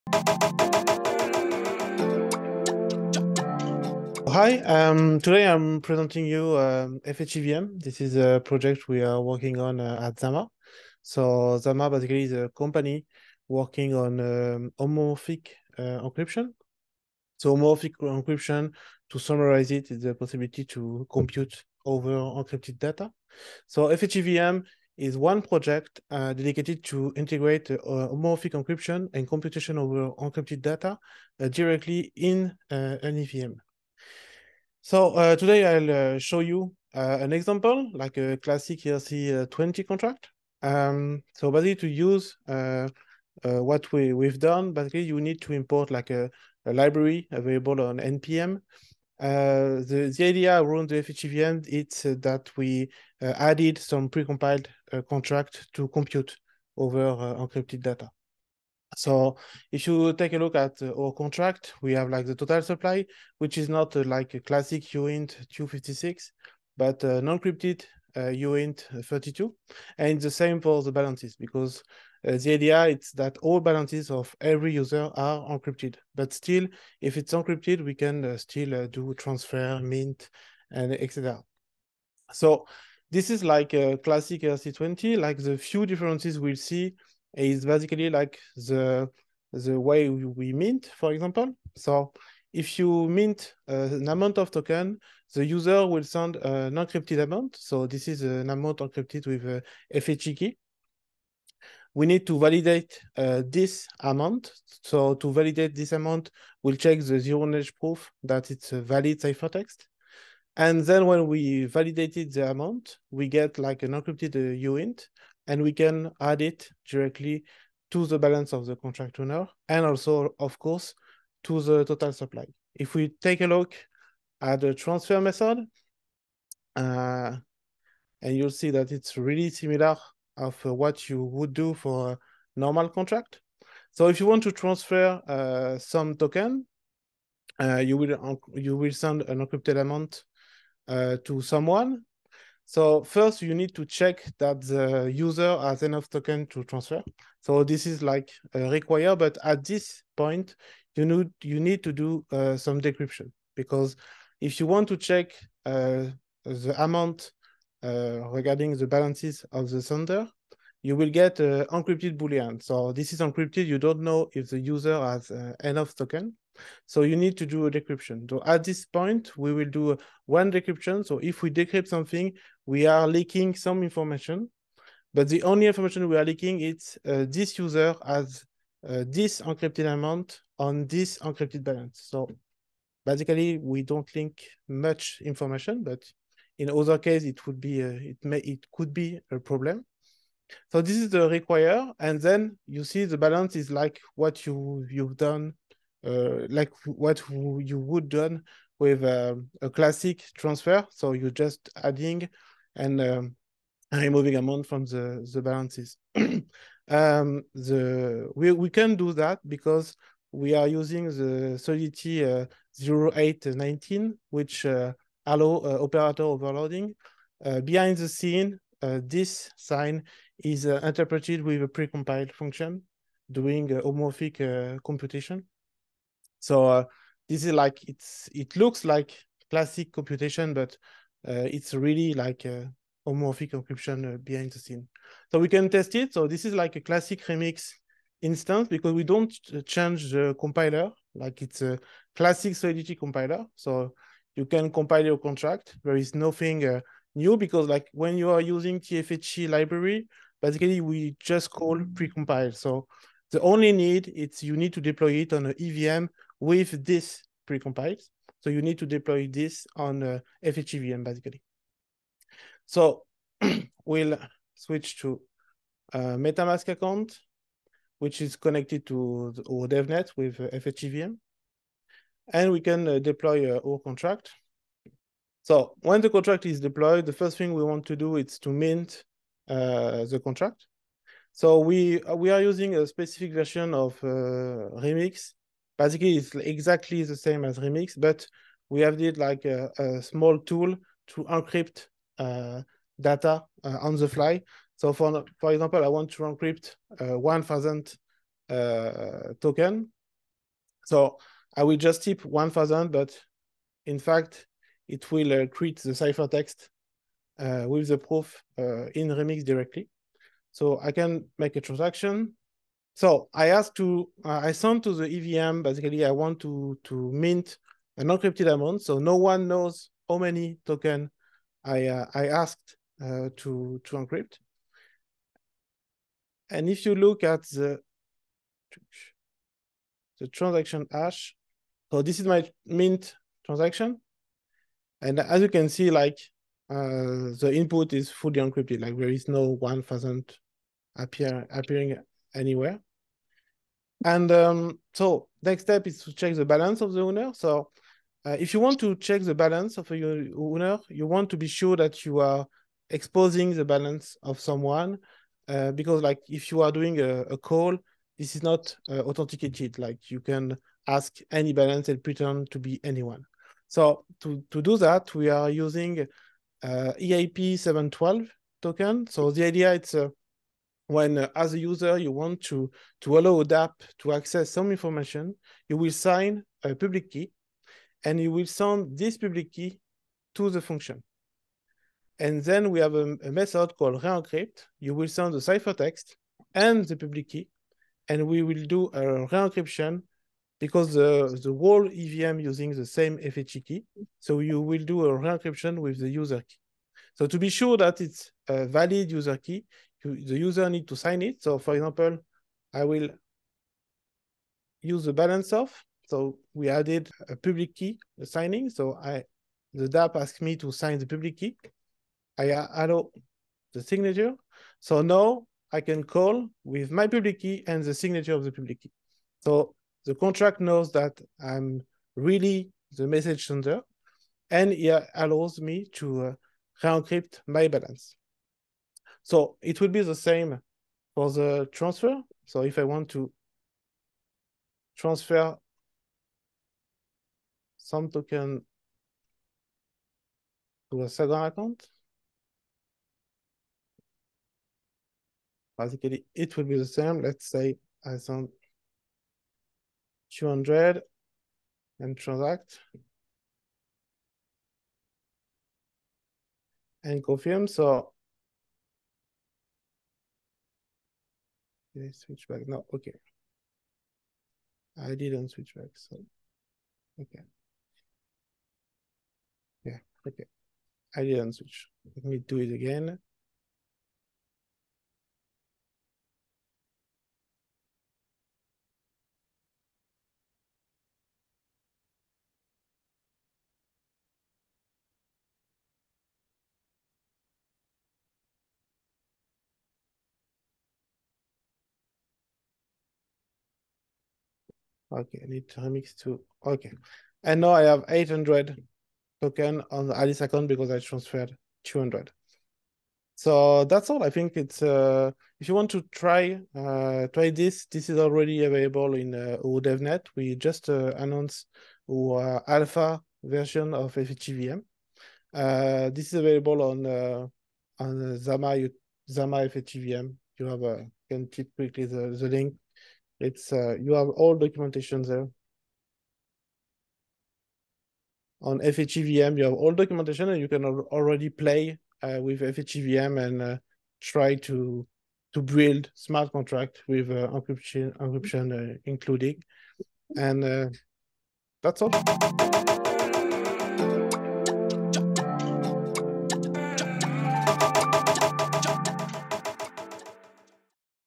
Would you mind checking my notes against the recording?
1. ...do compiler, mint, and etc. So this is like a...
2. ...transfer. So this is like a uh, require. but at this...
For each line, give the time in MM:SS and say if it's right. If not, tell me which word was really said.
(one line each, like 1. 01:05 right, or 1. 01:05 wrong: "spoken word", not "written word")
1. 01:18 wrong: "transfer", not "compiler"
2. 02:26 right.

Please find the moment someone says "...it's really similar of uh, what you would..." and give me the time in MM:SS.
02:08.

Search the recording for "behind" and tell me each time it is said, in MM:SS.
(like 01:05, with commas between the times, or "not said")
03:37, 03:54.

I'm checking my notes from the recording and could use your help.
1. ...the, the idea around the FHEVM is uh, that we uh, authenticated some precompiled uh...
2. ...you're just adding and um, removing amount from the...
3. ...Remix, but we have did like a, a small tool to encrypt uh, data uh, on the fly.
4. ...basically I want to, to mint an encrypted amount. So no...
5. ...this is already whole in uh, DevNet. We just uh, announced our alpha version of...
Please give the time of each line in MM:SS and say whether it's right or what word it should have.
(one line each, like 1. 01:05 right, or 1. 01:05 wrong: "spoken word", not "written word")
1. 00:49 wrong: "added", not "authenticated"
2. 03:21 right
3. 04:47 right
4. 05:15 right
5. 08:27 wrong: "available", not "whole".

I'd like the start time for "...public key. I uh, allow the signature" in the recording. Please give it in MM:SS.
06:51.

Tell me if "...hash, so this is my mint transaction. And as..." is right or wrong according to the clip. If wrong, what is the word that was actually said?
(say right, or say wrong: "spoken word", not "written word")
right.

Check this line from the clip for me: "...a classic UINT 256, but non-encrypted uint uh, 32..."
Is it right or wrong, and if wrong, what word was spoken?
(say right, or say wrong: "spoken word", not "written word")
right.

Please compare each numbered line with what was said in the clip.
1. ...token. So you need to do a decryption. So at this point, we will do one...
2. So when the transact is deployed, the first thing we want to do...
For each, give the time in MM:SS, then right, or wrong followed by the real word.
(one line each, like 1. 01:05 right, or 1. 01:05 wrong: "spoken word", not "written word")
1. 02:45 right
2. 04:35 wrong: "contract", not "transact".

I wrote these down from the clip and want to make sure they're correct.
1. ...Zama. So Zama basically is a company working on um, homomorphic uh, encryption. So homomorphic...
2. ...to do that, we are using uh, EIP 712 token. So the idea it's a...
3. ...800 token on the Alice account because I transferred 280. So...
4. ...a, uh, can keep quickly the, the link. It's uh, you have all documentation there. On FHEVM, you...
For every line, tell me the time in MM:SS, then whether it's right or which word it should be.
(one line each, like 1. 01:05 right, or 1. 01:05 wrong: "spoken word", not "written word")
1. 00:10 right
2. 06:04 right
3. 08:18 wrong: "200", not "280"
4. 08:40 right.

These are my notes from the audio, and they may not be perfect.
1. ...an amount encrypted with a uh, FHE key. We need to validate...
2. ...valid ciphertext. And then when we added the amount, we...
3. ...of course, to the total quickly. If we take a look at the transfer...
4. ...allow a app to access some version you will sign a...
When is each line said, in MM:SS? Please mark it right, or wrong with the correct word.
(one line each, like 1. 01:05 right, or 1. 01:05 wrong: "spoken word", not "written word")
1. 01:38 right
2. 01:48 wrong: "validated", not "added"
3. 02:00 wrong: "supply", not "quickly"
4. 06:13 wrong: "information", not "version".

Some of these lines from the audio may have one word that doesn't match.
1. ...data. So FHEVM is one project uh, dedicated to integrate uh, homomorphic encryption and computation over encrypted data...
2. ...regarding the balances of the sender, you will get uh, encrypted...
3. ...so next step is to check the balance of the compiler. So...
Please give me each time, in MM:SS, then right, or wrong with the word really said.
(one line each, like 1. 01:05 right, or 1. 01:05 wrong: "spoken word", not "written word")
1. 00:22 right
2. 02:38 right
3. 05:44 wrong: "owner", not "compiler".